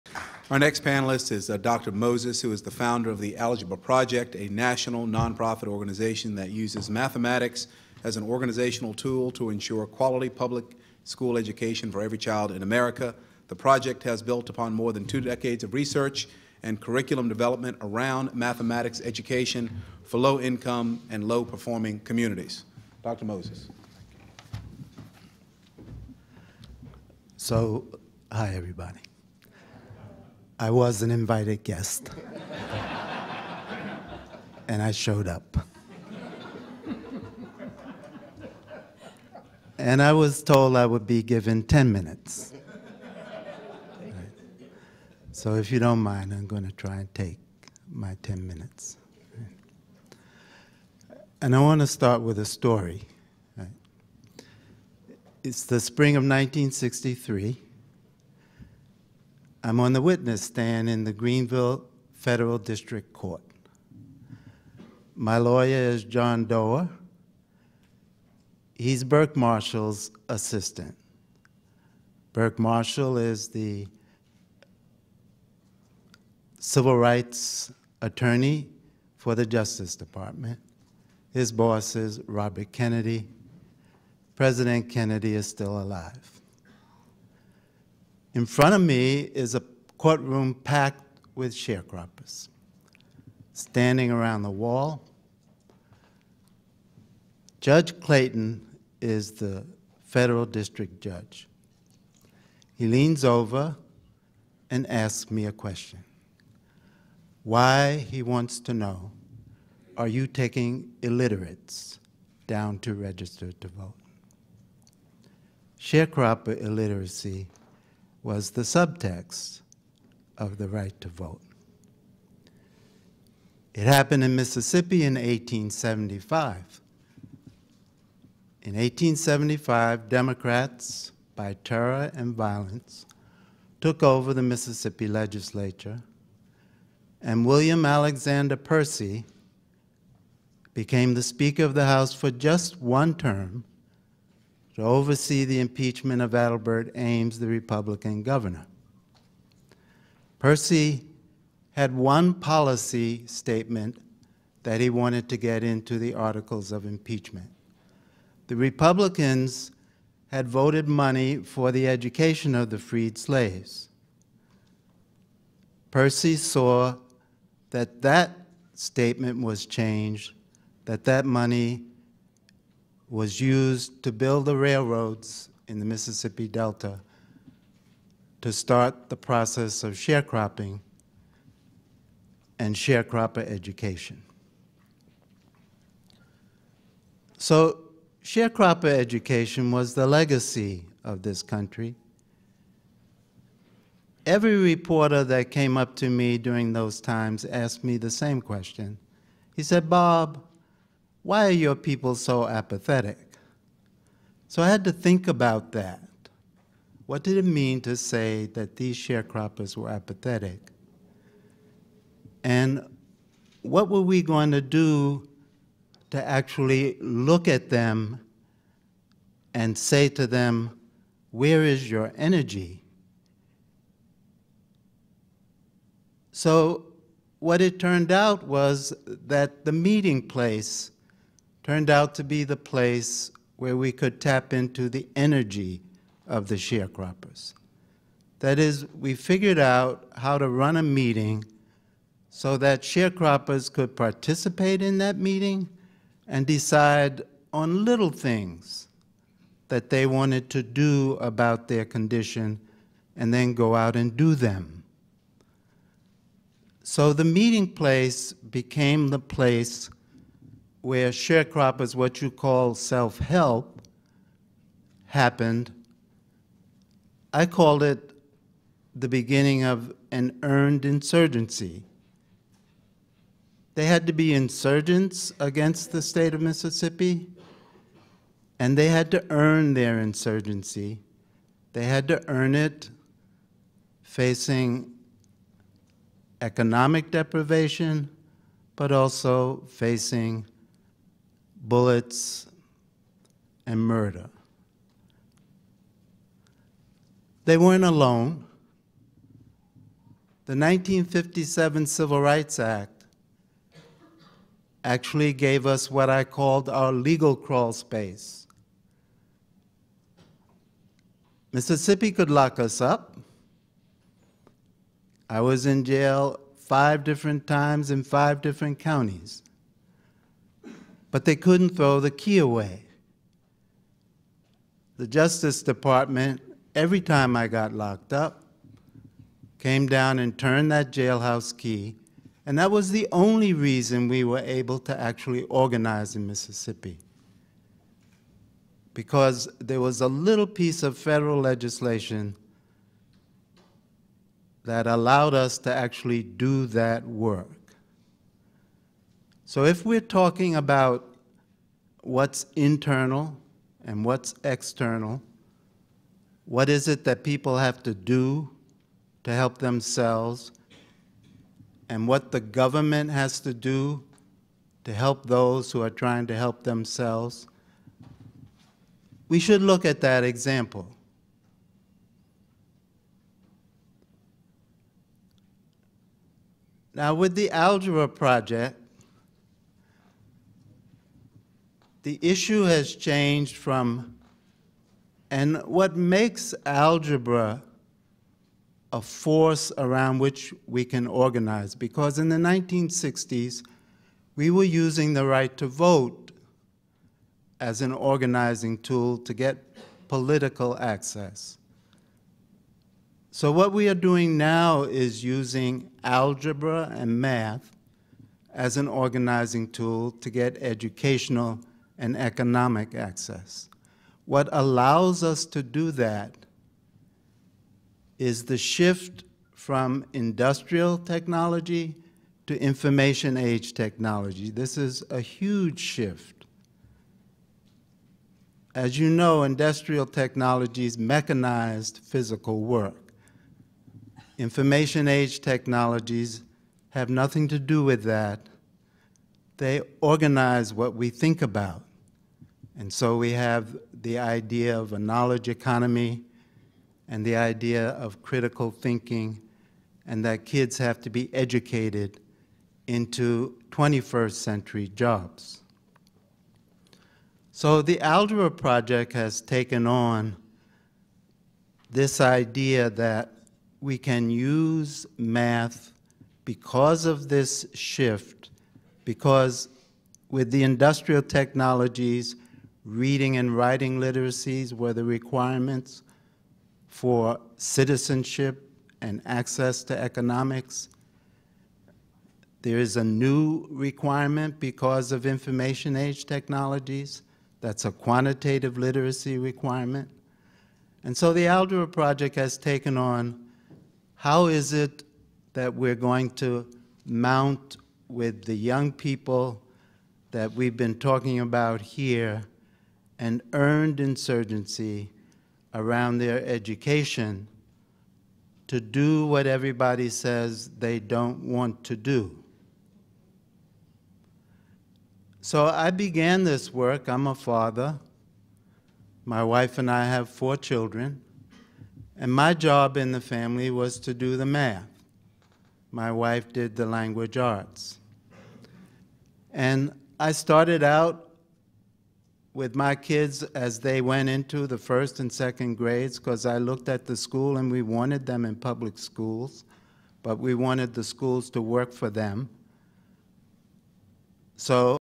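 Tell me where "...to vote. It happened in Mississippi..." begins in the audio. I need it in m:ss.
2:01.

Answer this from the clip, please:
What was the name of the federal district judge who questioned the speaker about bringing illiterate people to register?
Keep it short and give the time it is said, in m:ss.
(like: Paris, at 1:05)
Judge Clayton, at 1:37.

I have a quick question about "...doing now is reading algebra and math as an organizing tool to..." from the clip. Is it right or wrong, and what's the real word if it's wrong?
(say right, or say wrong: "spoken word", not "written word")
wrong: "using", not "reading".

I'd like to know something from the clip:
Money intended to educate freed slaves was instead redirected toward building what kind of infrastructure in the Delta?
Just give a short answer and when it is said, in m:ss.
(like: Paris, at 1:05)
railroads, at 2:54.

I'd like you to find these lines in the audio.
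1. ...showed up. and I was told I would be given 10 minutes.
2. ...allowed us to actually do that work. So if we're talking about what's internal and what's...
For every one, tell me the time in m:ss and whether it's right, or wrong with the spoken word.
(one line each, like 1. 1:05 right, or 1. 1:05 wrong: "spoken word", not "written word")
1. 0:34 right
2. 5:44 right.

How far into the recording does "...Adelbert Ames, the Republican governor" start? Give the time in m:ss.
2:26.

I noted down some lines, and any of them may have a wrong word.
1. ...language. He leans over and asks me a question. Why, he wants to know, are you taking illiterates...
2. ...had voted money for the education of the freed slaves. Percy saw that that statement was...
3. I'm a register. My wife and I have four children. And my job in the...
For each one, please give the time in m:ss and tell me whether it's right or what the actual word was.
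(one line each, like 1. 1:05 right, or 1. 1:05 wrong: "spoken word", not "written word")
1. 1:41 wrong: "judge", not "language"
2. 2:40 right
3. 8:37 wrong: "father", not "register".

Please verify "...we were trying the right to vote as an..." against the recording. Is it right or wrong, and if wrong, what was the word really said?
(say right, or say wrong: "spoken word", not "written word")
wrong: "using", not "trying".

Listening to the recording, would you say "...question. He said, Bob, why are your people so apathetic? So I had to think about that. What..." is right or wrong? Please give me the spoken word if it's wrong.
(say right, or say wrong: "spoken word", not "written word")
right.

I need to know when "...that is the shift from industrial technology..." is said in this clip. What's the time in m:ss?
6:55.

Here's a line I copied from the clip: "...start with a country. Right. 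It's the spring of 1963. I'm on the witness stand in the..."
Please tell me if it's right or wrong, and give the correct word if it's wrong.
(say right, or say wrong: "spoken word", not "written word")
wrong: "story", not "country".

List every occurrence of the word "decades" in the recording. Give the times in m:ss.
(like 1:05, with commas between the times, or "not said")
0:15.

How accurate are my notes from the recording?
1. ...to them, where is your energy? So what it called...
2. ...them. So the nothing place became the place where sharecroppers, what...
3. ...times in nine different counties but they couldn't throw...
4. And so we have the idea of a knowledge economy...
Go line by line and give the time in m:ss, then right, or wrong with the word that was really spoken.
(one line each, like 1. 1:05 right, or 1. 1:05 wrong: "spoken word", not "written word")
1. 3:40 wrong: "turned", not "called"
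2. 4:14 wrong: "meeting", not "nothing"
3. 5:17 wrong: "five", not "nine"
4. 7:22 right.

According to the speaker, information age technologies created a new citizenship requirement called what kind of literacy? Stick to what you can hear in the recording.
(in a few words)
quantitative literacy.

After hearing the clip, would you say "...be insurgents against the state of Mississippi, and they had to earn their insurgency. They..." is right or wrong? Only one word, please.
right.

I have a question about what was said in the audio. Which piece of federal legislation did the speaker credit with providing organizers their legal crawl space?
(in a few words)
1957 Civil Rights Act.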